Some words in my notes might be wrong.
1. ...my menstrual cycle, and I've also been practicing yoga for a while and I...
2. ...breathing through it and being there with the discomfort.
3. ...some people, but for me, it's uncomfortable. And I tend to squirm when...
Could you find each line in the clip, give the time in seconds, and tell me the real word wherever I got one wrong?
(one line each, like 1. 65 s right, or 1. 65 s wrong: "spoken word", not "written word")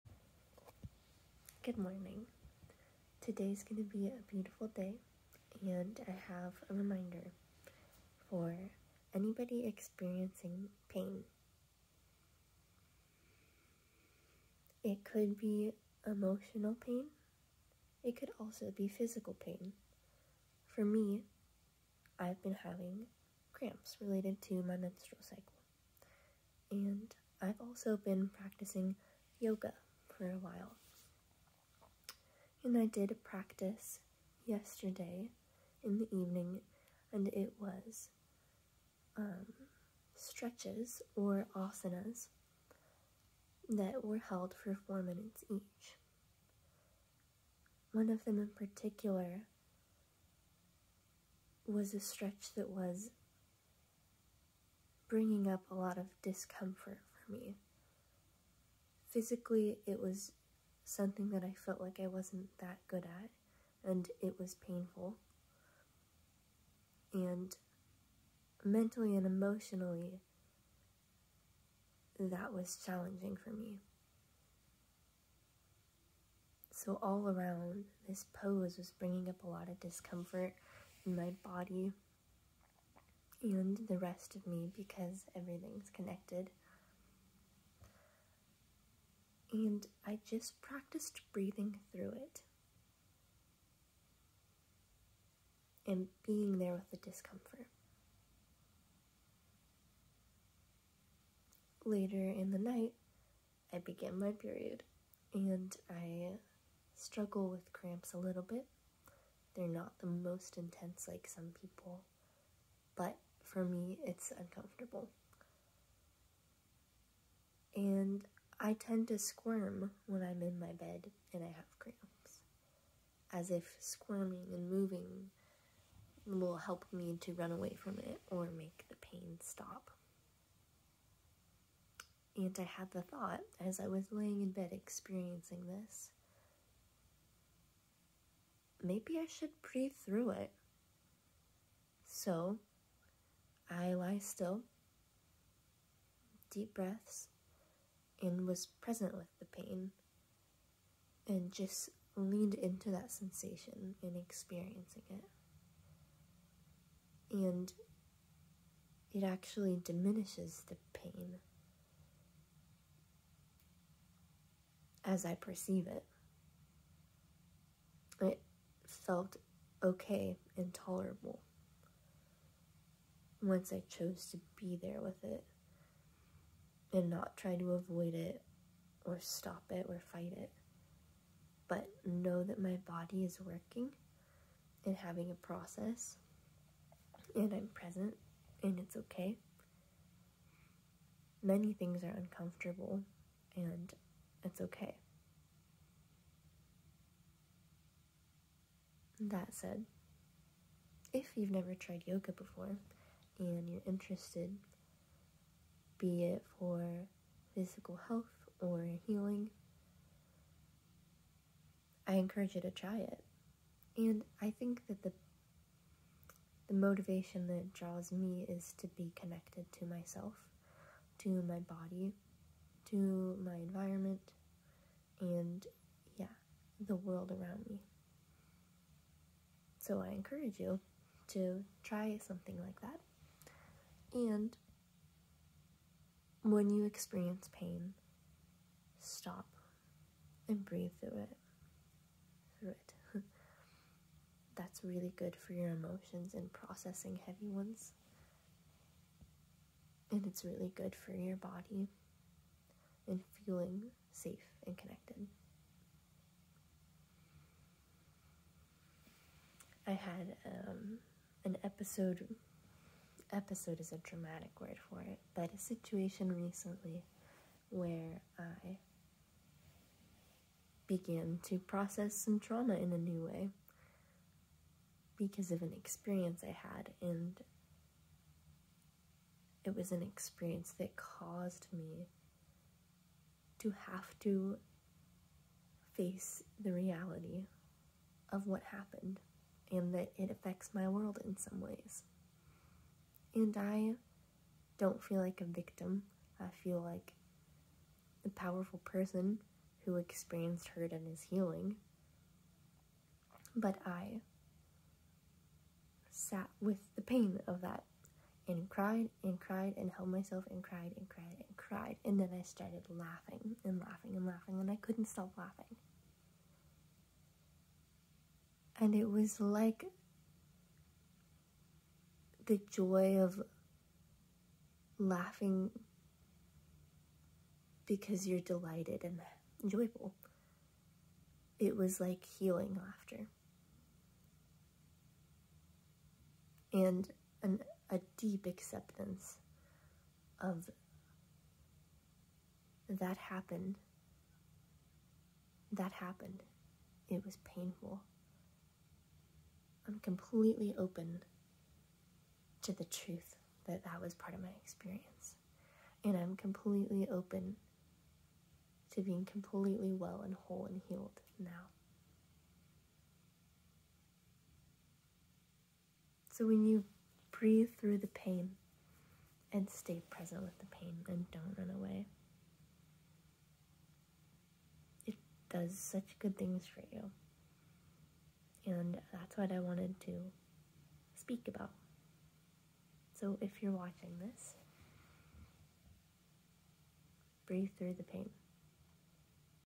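1. 24 s right
2. 91 s right
3. 111 s right.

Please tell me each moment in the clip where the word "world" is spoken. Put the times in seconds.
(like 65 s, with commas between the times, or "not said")
226 s, 290 s.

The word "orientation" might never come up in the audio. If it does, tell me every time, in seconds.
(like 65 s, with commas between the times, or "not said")
not said.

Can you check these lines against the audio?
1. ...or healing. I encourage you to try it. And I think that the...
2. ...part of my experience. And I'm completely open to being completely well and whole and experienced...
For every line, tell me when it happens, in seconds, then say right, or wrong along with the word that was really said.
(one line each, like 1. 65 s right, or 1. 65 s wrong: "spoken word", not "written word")
1. 208 s right
2. 354 s wrong: "healed", not "experienced".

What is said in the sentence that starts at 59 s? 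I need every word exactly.
Physically, it was something that I felt like I wasn't that good at, and it was painful.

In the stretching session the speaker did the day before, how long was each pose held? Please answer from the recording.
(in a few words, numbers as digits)
4 minutes.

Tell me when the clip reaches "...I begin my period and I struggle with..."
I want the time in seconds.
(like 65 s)
103 s.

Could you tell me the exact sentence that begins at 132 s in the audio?
And I had the thought as I was laying in bed experiencing this maybe I should breathe through it.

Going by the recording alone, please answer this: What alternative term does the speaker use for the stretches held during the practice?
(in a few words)
asanas.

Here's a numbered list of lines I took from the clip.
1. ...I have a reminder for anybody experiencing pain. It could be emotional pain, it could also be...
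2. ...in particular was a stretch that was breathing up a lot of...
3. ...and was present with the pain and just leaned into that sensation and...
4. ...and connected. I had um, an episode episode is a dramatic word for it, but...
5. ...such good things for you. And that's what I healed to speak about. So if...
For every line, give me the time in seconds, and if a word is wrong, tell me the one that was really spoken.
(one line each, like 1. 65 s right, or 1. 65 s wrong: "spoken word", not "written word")
1. 6 s right
2. 48 s wrong: "bringing", not "breathing"
3. 148 s right
4. 254 s right
5. 375 s wrong: "wanted", not "healed".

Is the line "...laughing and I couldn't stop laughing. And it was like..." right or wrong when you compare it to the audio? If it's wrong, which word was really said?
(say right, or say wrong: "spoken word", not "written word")
right.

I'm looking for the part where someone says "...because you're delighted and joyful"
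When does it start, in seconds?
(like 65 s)
327 s.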